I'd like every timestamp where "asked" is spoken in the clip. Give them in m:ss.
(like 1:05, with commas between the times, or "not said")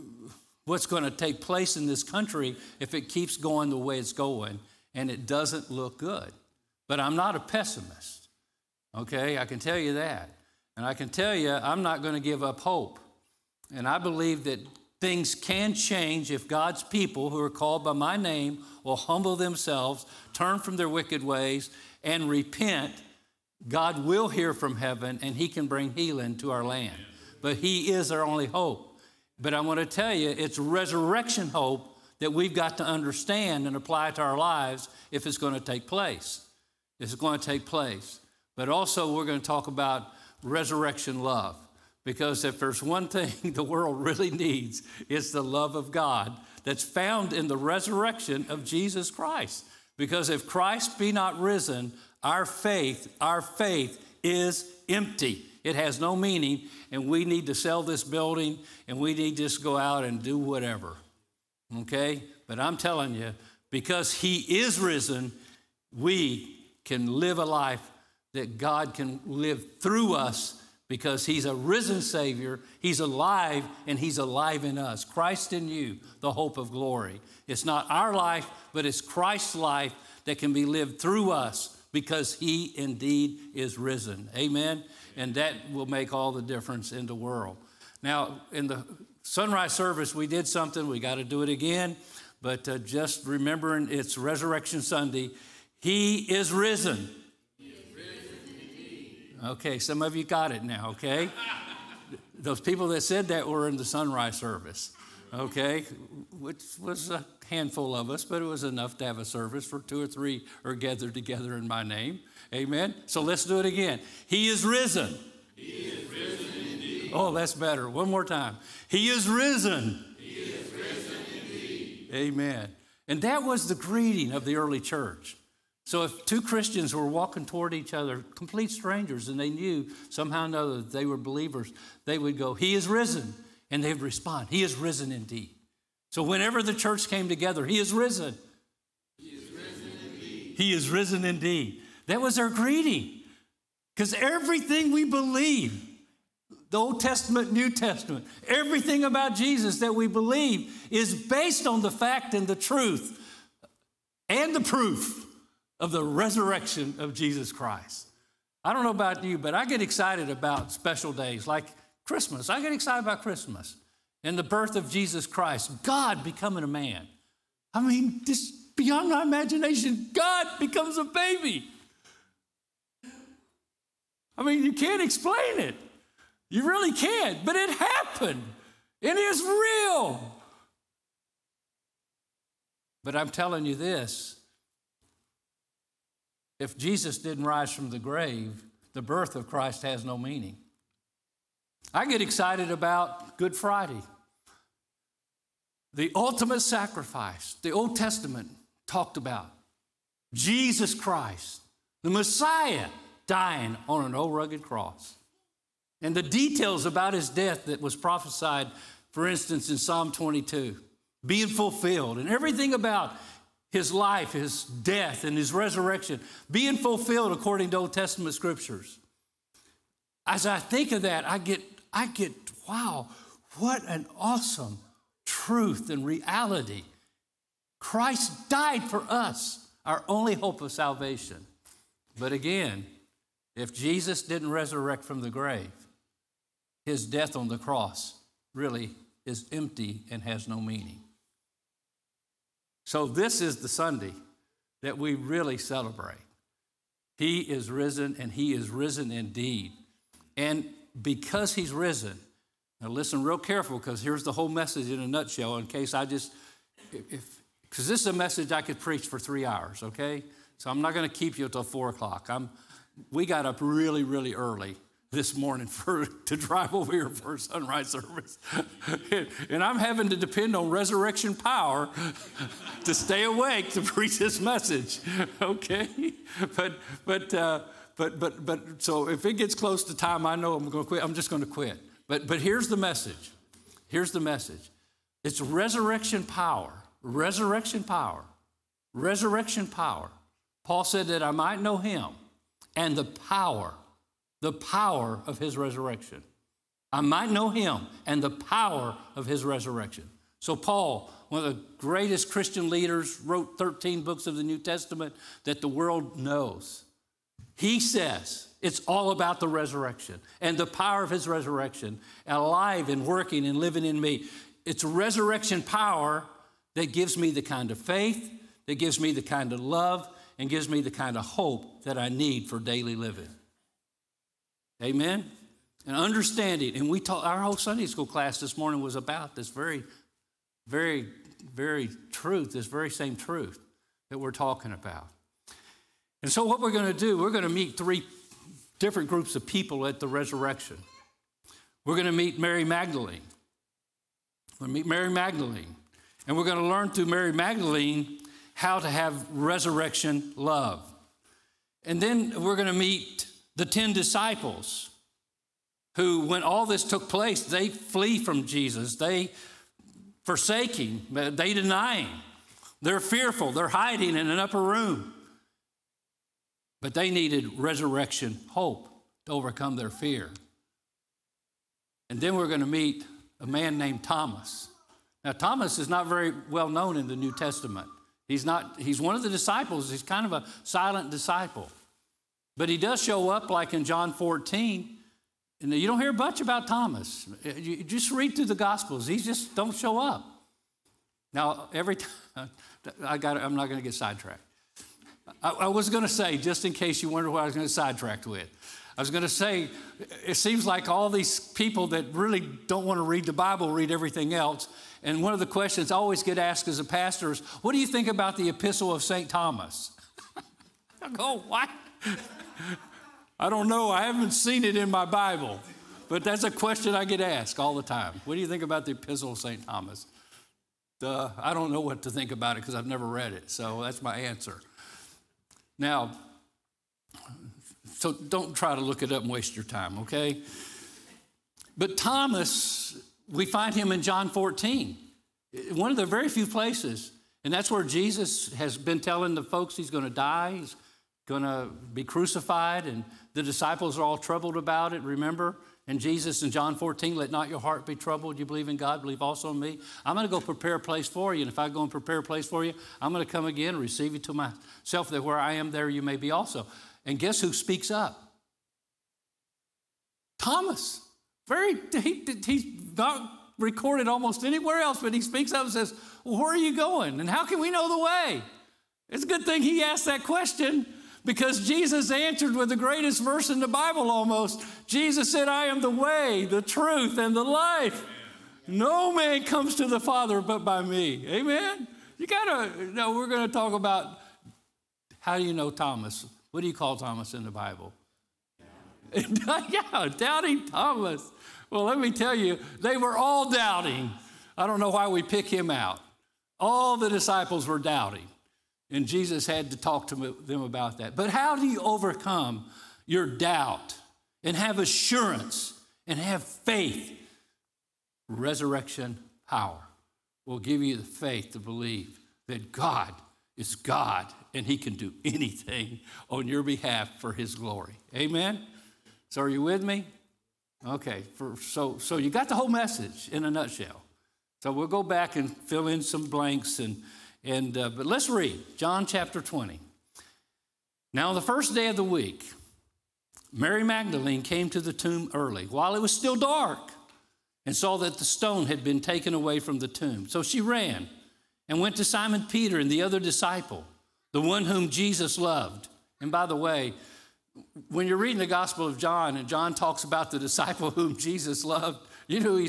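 6:46, 6:57, 7:49.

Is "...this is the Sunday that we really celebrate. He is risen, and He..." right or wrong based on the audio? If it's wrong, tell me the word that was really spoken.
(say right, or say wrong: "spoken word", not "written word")
right.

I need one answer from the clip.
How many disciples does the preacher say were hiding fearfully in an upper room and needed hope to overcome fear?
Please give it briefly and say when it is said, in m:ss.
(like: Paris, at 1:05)
10, at 5:53.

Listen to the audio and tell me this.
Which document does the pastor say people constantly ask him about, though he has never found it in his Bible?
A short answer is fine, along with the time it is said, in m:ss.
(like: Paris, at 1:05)
Epistle of Saint Thomas, at 6:48.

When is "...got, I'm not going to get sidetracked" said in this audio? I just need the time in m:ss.
6:33.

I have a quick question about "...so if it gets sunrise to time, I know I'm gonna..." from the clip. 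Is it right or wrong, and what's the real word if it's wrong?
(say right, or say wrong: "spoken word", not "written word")
wrong: "close", not "sunrise".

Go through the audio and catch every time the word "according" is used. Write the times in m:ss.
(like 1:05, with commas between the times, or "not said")
3:37.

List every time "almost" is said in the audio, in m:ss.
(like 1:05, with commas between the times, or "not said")
7:44, 7:54.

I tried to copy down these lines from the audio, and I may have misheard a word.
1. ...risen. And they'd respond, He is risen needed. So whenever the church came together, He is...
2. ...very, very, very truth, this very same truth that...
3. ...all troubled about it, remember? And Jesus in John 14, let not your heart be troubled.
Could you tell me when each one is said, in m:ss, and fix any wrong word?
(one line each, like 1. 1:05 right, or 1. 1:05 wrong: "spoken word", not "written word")
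1. 2:12 wrong: "indeed", not "needed"
2. 5:29 right
3. 7:24 right.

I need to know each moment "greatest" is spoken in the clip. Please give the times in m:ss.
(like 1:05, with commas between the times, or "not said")
5:01, 7:52.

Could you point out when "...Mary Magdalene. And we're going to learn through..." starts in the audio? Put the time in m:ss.
5:44.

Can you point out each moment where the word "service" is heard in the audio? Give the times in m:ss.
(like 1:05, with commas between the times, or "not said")
1:29, 1:44, 1:49, 4:27.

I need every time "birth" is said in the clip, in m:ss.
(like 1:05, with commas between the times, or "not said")
2:44, 3:09.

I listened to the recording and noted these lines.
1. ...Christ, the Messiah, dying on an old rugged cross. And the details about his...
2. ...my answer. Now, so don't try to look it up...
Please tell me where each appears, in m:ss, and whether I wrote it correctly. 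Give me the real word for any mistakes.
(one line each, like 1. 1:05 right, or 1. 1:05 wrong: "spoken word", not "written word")
1. 3:20 right
2. 7:04 right.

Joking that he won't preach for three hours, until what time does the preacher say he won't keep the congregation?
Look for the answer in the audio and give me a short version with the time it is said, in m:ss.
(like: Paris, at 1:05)
four o'clock, at 4:21.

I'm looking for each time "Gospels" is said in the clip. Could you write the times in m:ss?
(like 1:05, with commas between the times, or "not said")
6:28, 9:08.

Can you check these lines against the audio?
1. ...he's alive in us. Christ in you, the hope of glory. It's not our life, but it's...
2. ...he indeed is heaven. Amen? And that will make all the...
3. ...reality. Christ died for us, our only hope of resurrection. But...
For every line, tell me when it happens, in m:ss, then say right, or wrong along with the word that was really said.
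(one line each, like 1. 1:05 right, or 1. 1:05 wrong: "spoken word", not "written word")
1. 1:13 right
2. 1:22 wrong: "risen", not "heaven"
3. 3:46 wrong: "salvation", not "resurrection".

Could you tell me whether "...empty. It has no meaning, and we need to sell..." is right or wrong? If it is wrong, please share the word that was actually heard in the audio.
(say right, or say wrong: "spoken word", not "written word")
right.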